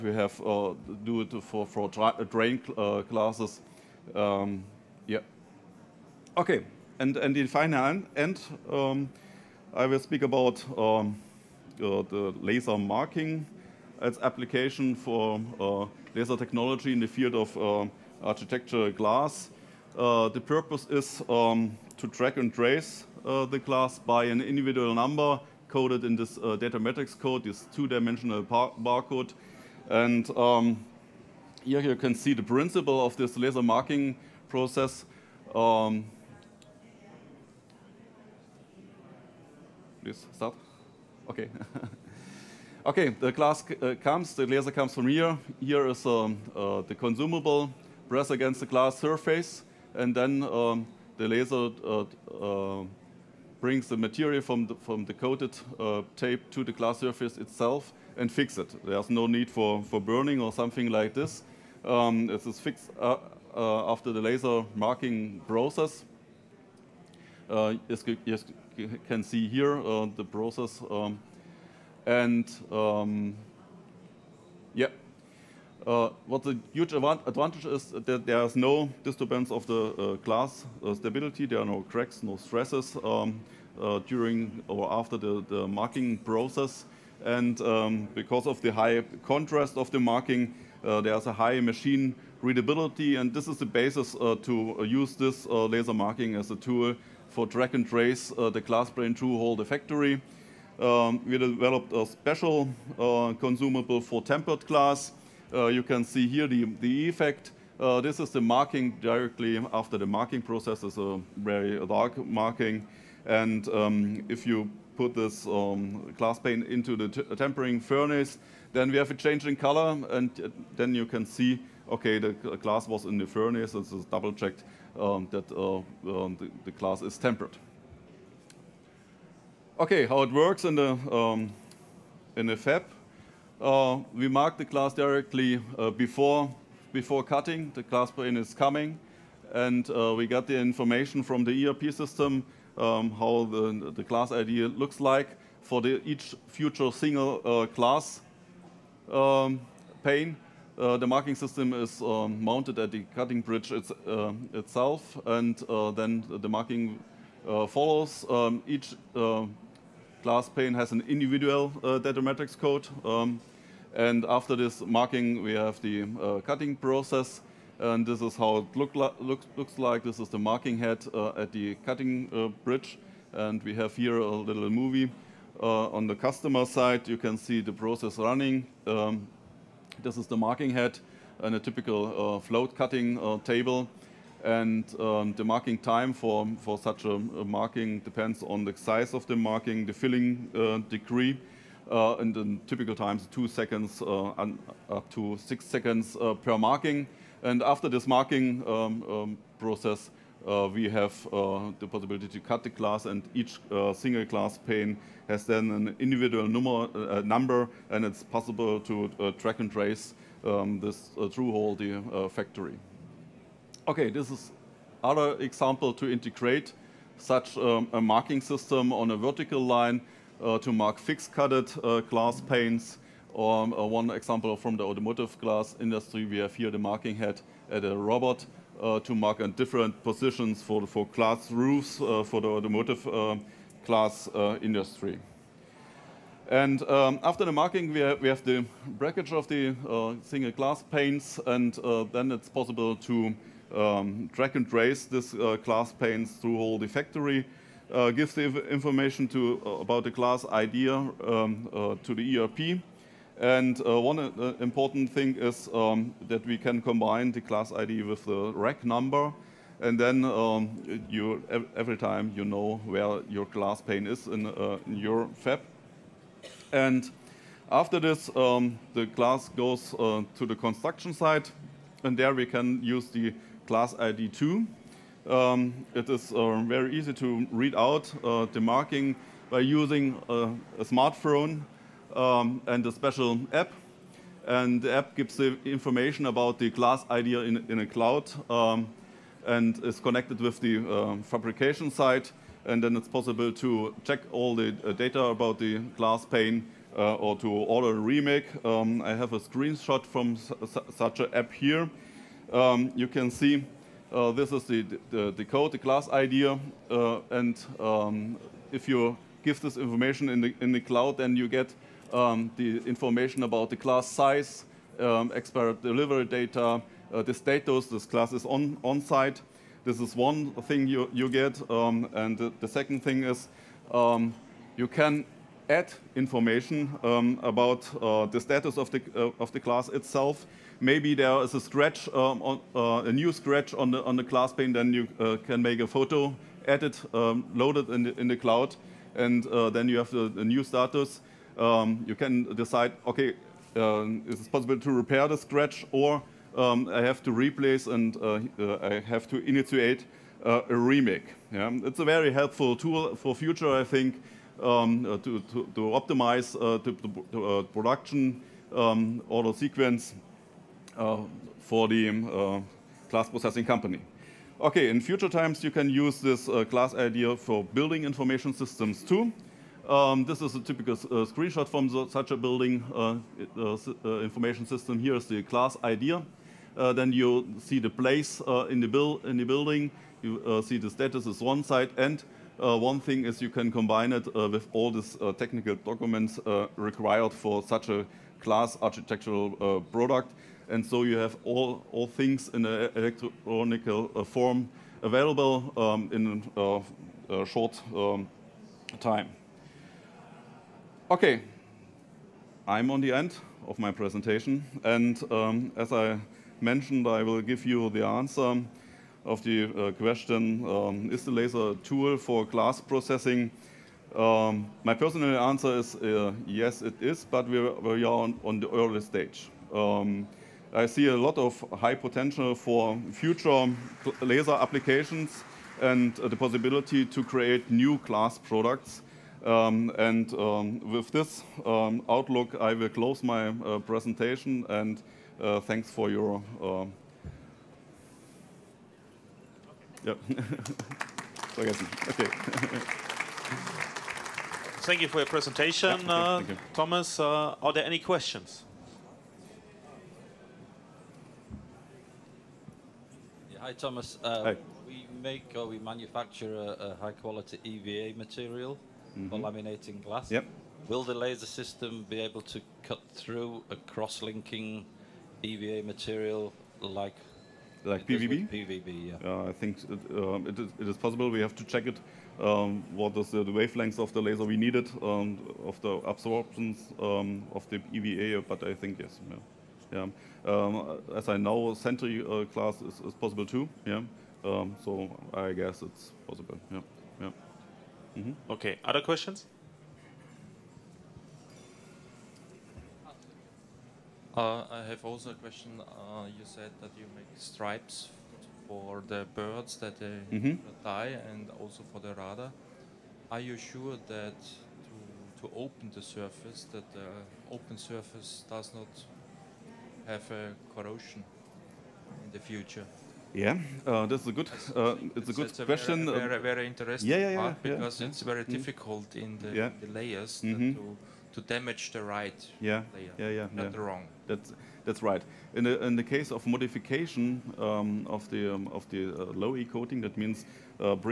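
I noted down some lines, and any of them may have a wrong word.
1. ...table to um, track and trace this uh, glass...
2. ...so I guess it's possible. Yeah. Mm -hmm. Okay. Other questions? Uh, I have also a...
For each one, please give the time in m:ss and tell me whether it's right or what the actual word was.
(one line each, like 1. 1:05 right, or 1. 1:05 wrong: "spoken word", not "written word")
1. 4:02 wrong: "possible", not "table"
2. 8:04 right.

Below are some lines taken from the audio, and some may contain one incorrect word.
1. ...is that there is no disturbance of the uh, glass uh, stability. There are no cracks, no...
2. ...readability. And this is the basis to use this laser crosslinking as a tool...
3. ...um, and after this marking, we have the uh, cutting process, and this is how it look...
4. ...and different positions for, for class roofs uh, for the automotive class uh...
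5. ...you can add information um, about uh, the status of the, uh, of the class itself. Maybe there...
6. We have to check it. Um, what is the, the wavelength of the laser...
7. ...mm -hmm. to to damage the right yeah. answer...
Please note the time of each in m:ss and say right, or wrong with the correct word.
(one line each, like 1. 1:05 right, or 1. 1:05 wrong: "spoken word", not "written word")
1. 1:17 right
2. 1:32 wrong: "marking", not "crosslinking"
3. 2:43 right
4. 3:49 right
5. 5:24 right
6. 7:51 right
7. 8:40 wrong: "layer", not "answer".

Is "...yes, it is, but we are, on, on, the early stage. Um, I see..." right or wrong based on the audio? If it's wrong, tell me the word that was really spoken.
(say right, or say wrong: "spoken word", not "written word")
right.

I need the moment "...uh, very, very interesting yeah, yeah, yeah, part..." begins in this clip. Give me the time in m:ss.
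8:36.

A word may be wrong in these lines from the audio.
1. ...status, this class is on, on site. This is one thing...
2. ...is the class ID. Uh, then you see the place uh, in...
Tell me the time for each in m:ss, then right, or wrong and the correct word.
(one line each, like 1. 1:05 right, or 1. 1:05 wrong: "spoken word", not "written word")
1. 5:17 right
2. 6:15 right.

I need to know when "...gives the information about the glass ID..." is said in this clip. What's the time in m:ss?
4:45.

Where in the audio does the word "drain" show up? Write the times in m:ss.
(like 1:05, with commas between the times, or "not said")
0:02.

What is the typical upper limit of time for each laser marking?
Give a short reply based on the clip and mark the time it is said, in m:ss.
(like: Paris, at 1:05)
6 seconds, at 3:15.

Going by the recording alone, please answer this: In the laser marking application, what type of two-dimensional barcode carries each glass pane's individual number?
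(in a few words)
data code.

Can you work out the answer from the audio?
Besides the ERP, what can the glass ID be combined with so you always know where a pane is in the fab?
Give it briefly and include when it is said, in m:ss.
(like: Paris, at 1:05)
the rack number, at 4:18.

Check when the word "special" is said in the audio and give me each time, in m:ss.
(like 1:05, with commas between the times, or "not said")
1:42, 4:42.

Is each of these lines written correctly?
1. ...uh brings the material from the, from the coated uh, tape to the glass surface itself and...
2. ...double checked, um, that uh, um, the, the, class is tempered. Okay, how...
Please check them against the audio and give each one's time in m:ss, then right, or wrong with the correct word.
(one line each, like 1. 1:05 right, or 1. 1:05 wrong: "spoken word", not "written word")
1. 0:52 right
2. 2:04 right.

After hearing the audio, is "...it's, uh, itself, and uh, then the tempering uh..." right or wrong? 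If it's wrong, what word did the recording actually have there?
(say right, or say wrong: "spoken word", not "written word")
wrong: "marking", not "tempering".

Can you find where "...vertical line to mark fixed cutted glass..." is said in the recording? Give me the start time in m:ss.
3:39.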